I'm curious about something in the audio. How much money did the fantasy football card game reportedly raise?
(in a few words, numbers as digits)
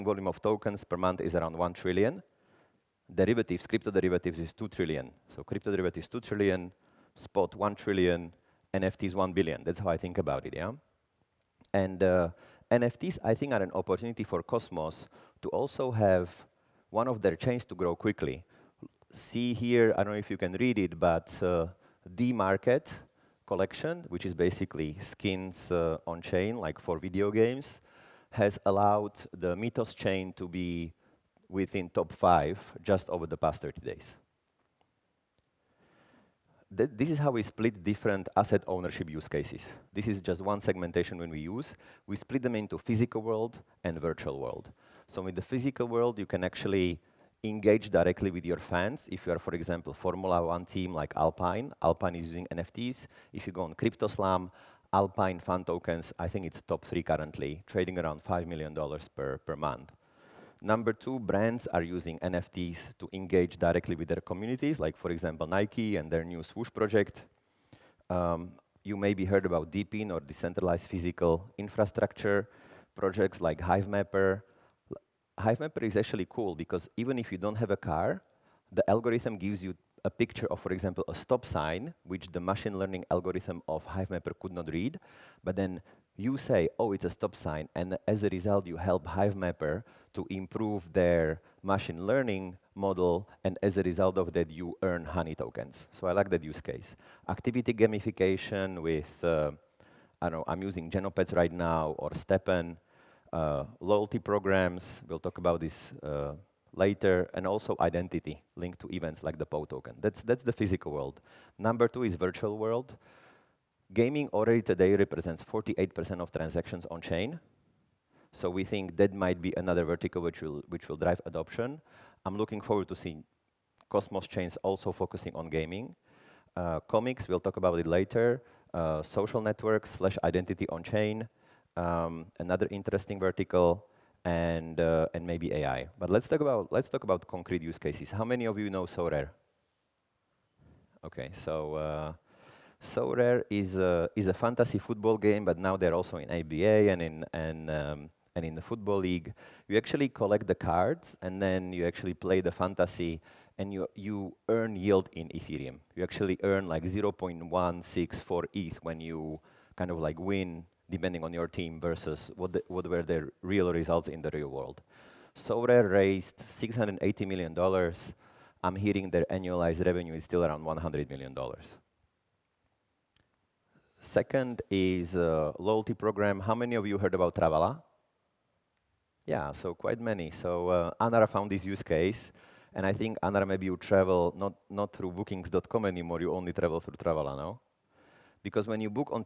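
$680 million.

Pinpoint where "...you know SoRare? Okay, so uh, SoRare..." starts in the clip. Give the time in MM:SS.
02:18.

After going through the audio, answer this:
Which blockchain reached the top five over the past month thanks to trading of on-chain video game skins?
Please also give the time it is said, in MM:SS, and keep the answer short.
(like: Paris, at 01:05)
Mythos, at 00:29.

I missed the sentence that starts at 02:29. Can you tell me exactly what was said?
You actually collect the cards, and then you actually play the fantasy, and you you earn yield in Ethereum.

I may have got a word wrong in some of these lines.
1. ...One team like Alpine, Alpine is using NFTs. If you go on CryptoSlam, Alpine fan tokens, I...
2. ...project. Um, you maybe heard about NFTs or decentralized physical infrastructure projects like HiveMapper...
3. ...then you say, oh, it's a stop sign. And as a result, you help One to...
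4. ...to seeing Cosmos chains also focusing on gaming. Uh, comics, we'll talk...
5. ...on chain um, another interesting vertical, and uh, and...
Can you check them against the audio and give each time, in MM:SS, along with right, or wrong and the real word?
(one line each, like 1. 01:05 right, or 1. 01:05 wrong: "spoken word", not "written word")
1. 00:50 right
2. 01:06 wrong: "DePIN", not "NFTs"
3. 01:25 wrong: "HiveMapper", not "One"
4. 02:02 right
5. 02:10 right.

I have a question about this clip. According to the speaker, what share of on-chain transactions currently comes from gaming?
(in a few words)
48%.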